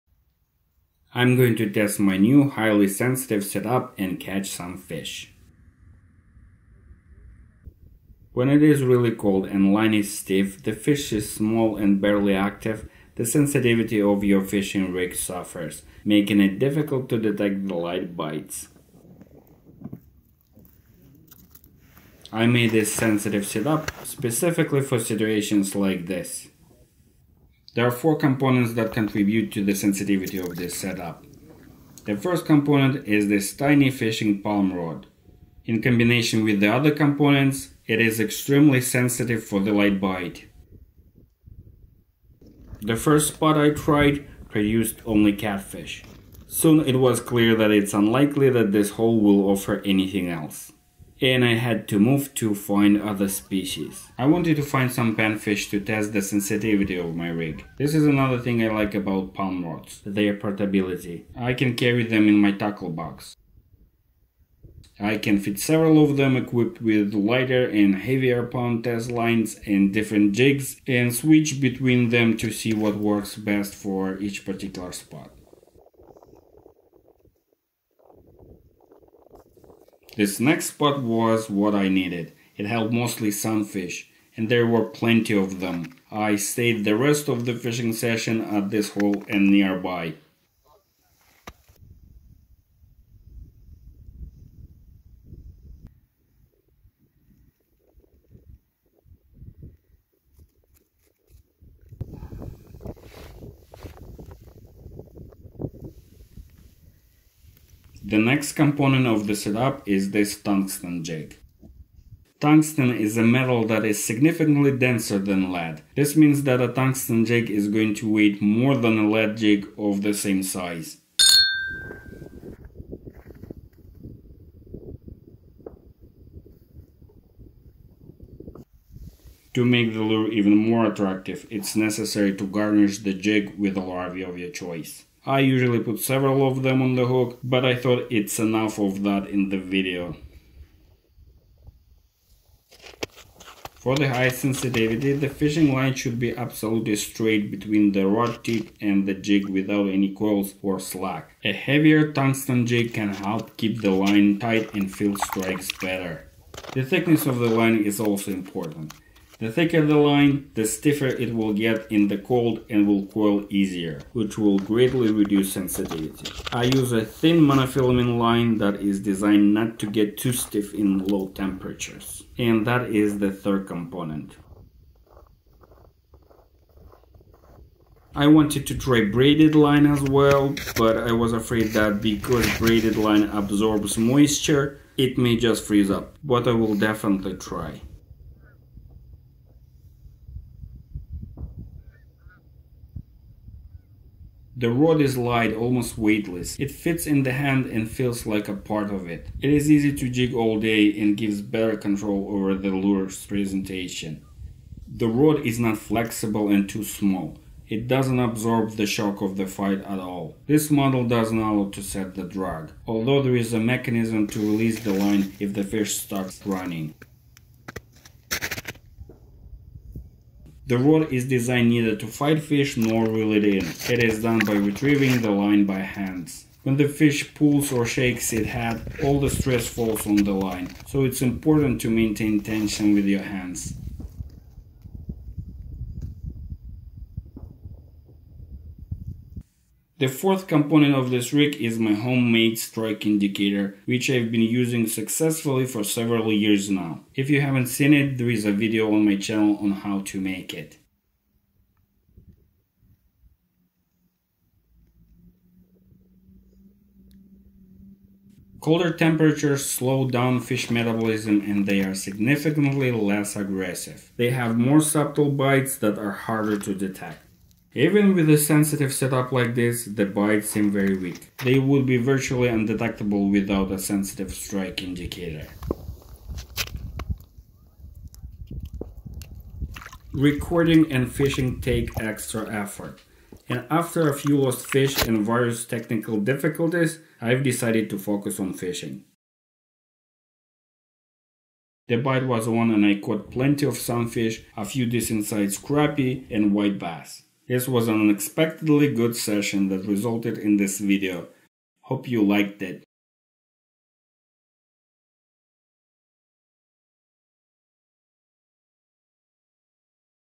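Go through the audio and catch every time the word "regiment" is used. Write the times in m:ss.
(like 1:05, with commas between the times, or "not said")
not said.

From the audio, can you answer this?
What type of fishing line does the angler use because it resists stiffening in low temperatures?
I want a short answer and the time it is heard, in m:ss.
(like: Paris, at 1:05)
thin monofilament, at 2:47.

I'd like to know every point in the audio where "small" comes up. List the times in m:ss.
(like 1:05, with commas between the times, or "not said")
0:11, 3:26.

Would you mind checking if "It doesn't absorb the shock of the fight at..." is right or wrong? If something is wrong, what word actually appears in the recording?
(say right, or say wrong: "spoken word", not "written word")
right.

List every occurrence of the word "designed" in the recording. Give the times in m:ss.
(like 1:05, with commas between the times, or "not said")
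2:48, 3:41.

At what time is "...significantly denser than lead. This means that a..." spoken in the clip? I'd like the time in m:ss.
1:54.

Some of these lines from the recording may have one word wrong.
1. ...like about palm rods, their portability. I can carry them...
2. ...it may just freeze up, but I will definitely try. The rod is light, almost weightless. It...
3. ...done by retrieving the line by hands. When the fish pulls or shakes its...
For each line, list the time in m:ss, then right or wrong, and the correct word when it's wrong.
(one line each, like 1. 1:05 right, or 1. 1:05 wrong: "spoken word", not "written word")
1. 0:58 right
2. 3:04 right
3. 3:44 right.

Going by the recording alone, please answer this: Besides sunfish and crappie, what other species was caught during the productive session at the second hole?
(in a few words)
white bass.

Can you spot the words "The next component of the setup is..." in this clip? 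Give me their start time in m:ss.
1:48.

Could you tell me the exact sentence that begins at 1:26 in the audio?
I stayed the rest of the fishing session at this hole and nearby.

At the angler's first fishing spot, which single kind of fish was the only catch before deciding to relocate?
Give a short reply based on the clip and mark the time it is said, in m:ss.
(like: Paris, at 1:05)
catfish, at 0:45.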